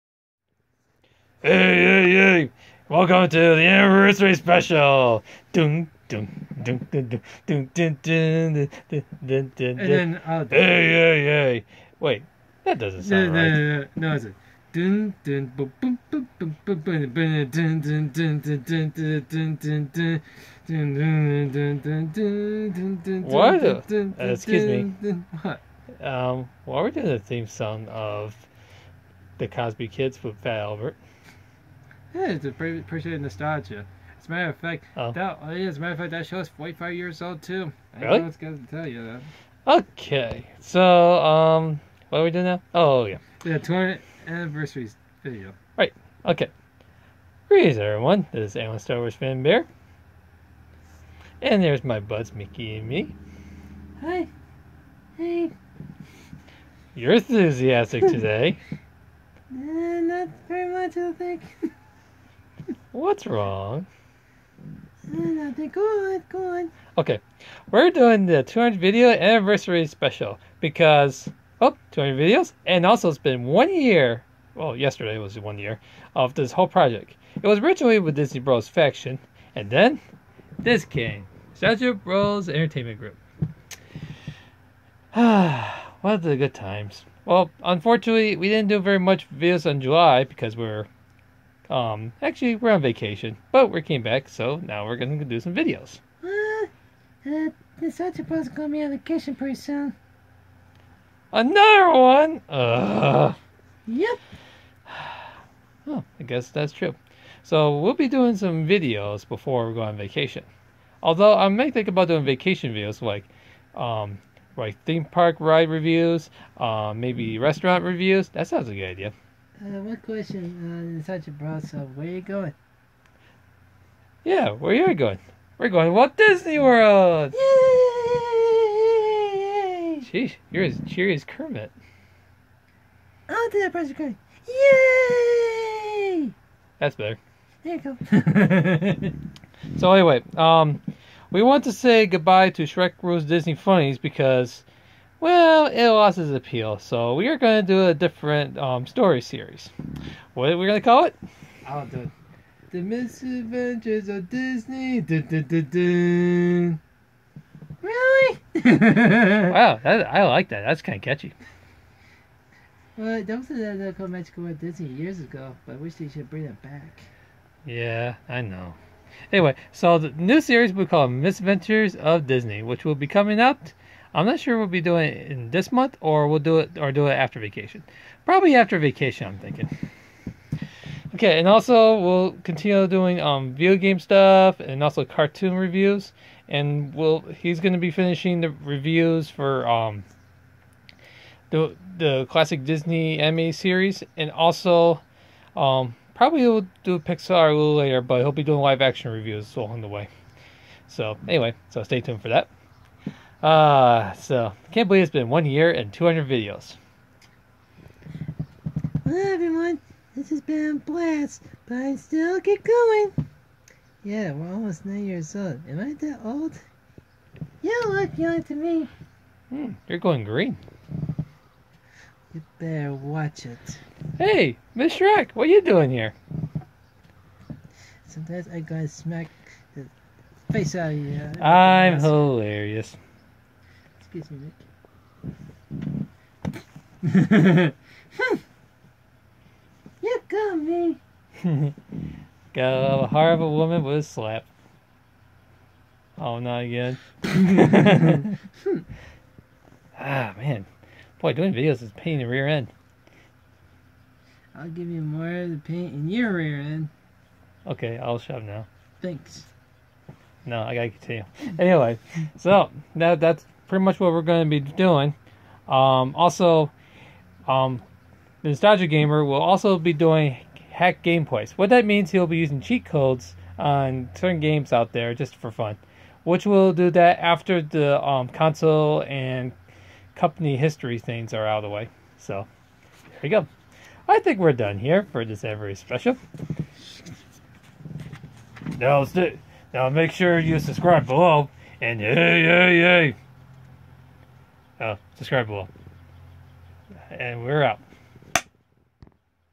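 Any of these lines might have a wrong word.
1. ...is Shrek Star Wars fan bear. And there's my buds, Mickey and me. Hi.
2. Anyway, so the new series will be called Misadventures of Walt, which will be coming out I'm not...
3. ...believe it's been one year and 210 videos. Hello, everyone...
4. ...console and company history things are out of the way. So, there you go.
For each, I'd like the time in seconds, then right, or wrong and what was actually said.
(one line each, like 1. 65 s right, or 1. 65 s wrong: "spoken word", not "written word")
1. 48 s wrong: "Alan", not "Shrek"
2. 169 s wrong: "Disney", not "Walt"
3. 204 s wrong: "200", not "210"
4. 278 s right.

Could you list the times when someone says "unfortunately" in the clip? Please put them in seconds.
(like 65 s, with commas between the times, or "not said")
87 s.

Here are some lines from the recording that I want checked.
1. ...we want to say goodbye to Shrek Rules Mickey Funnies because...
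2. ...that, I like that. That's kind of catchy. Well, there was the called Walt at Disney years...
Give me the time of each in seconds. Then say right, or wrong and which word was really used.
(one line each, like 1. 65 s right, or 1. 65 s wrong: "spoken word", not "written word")
1. 141 s wrong: "Disney", not "Mickey"
2. 159 s wrong: "Magical", not "Walt".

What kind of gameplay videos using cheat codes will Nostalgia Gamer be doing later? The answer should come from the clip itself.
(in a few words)
Hack gameplays.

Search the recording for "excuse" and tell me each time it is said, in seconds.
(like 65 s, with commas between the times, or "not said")
24 s, 234 s.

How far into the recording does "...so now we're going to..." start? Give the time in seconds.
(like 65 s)
94 s.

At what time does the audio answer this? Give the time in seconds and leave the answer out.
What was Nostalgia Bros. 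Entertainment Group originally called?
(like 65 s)
78 s.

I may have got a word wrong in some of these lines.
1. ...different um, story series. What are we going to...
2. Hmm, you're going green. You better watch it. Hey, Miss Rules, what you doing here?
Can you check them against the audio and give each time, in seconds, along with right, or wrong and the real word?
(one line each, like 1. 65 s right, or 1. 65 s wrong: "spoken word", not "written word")
1. 147 s right
2. 219 s wrong: "Shrek", not "Rules".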